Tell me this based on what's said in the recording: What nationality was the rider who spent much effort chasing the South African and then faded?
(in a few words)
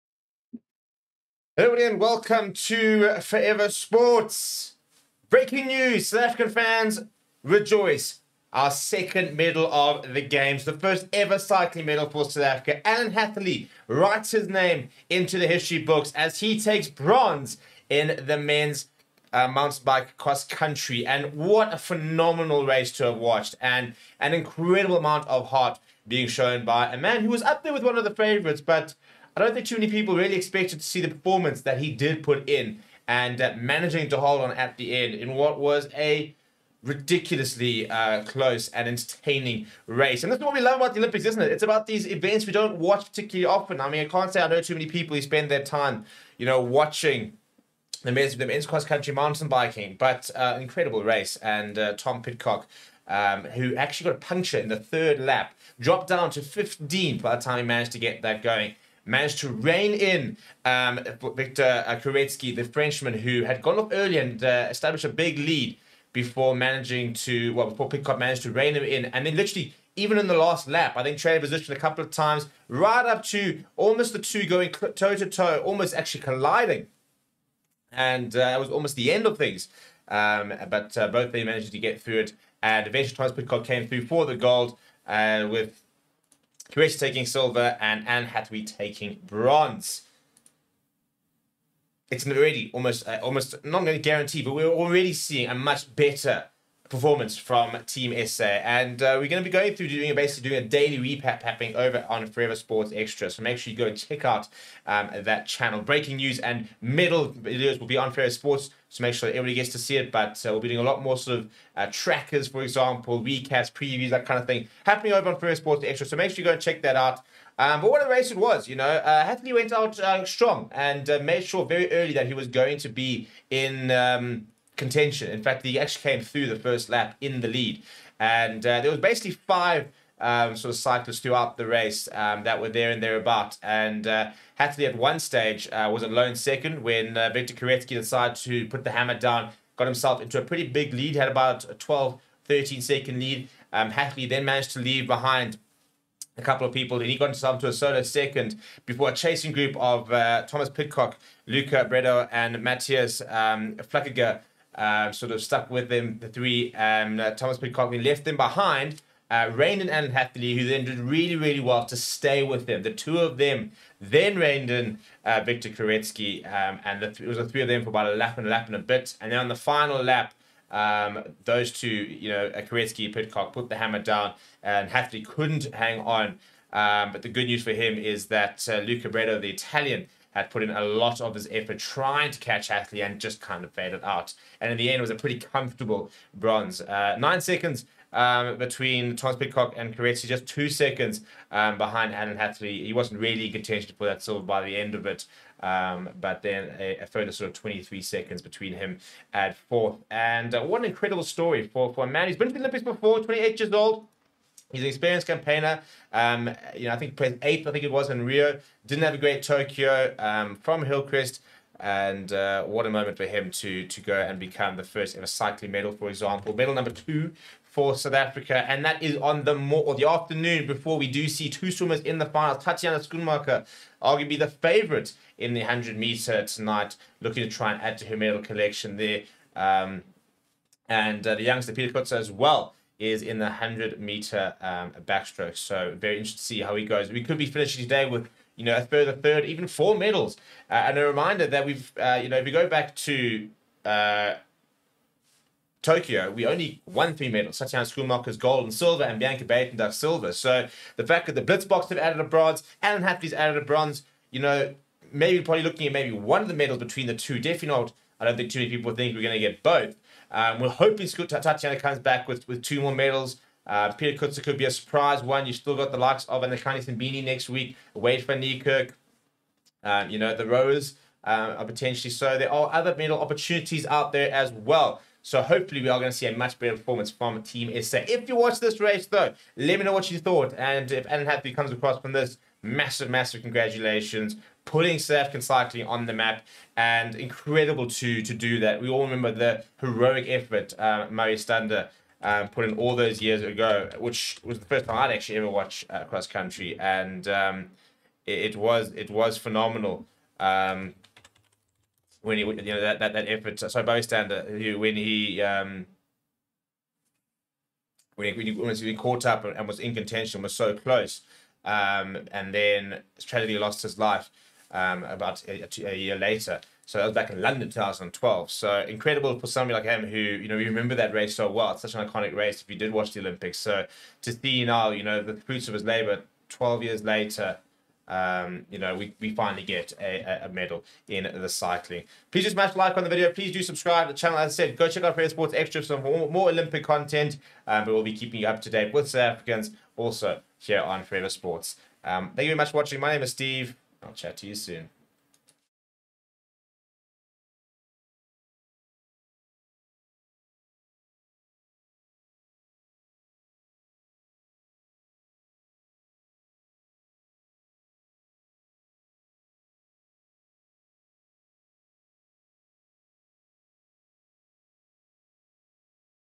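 Italian.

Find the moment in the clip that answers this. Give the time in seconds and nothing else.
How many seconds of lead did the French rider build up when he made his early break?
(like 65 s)
141 s.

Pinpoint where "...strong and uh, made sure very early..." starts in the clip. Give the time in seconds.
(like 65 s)
120 s.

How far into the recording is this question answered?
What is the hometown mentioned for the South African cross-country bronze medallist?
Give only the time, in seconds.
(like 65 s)
210 s.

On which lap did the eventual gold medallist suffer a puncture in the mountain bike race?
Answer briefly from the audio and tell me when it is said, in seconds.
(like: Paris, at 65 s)
third lap, at 54 s.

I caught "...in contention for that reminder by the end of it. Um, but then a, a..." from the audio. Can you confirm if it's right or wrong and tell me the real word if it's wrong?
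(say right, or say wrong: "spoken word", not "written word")
wrong: "silver", not "reminder".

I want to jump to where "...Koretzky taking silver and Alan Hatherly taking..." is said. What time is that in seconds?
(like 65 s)
86 s.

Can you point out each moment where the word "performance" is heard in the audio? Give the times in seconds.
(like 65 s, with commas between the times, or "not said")
31 s, 96 s, 276 s.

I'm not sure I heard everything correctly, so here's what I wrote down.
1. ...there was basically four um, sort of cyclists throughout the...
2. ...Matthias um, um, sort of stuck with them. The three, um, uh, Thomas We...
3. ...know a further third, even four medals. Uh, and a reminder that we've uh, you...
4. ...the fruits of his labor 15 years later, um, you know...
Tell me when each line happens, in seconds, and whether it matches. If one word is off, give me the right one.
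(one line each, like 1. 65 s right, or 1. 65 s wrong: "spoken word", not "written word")
1. 128 s wrong: "five", not "four"
2. 152 s right
3. 238 s right
4. 325 s wrong: "12", not "15".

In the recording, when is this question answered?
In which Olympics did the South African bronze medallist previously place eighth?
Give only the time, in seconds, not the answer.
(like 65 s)
208 s.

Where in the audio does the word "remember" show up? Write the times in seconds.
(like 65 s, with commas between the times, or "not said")
289 s, 320 s.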